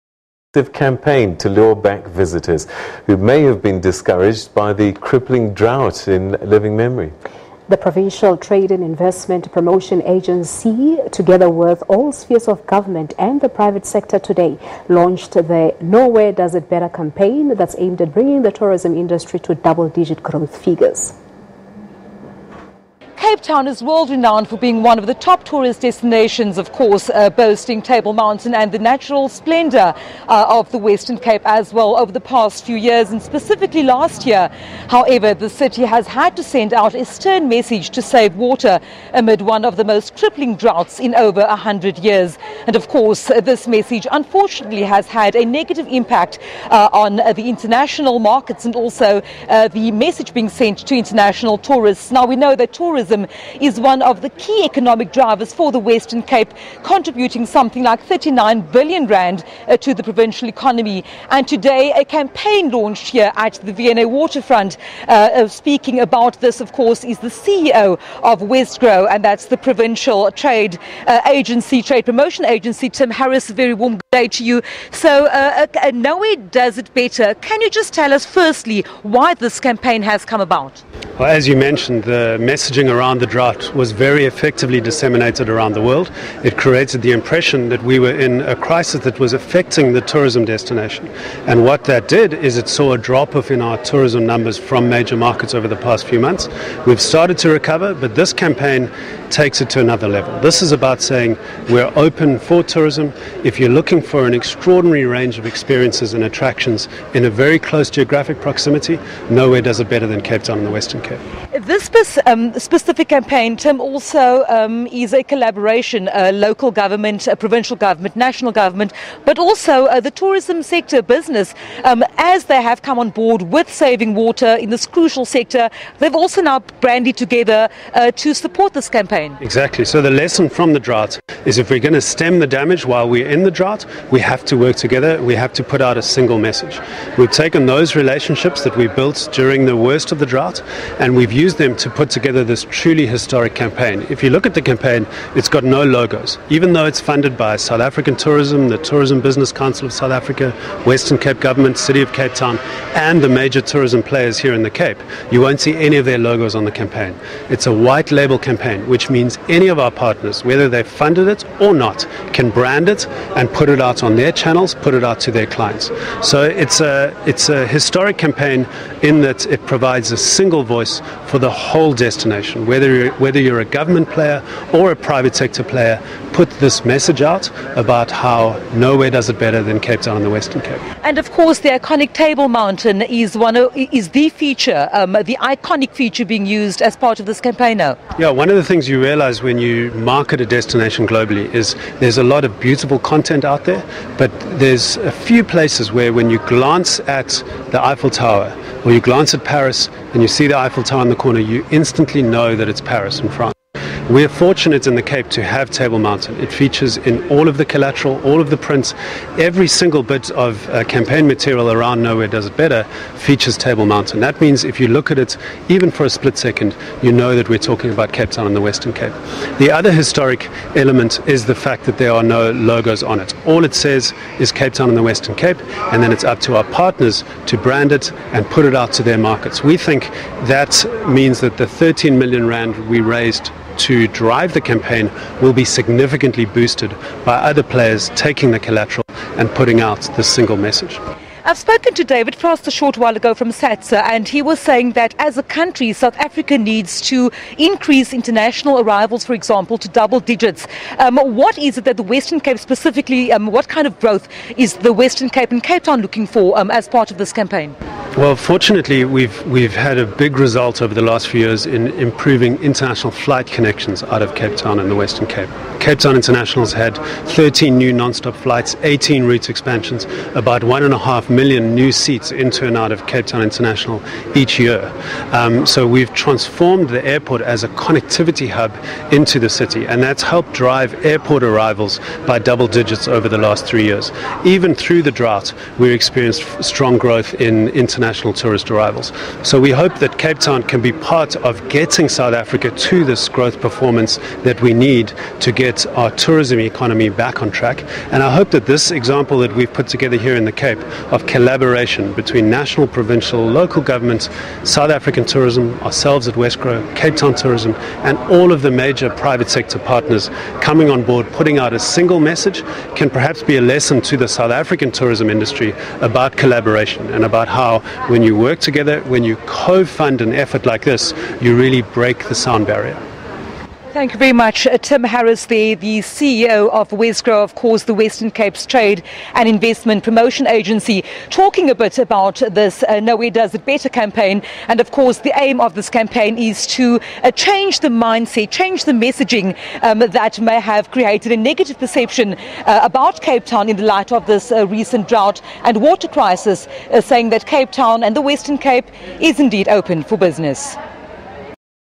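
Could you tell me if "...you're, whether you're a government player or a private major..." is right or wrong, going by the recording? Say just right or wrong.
wrong.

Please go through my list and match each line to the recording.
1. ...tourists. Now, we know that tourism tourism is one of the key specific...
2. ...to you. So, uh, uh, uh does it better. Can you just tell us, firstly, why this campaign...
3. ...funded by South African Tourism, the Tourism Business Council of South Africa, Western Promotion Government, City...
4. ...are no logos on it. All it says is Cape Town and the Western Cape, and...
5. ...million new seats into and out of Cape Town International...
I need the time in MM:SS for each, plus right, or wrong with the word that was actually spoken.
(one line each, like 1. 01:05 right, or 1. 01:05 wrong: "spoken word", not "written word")
1. 00:51 wrong: "economic", not "specific"
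2. 01:14 right
3. 02:26 wrong: "Cape", not "Promotion"
4. 03:42 right
5. 04:31 right.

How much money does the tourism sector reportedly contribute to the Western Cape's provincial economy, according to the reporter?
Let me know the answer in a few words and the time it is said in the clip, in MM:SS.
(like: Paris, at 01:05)
39 billion rand, at 00:58.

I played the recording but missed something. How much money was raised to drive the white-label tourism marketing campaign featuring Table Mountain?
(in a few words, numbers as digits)
13 million rand.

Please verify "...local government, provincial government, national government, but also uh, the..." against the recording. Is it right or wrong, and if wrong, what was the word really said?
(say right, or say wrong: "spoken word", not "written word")
right.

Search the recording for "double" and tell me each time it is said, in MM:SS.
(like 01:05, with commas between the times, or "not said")
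00:19, 04:09, 04:42.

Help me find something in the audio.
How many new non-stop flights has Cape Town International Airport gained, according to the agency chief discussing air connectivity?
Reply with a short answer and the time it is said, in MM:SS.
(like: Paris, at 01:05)
13, at 04:27.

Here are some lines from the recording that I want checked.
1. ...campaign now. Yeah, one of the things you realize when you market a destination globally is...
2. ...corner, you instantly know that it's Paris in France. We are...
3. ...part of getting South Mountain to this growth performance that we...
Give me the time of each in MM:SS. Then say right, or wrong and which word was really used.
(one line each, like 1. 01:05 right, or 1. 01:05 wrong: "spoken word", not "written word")
1. 03:07 right
2. 03:21 right
3. 04:50 wrong: "Africa", not "Mountain".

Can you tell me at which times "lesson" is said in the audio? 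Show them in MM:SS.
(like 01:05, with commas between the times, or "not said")
02:10, 05:13.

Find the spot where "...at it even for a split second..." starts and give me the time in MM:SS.
03:35.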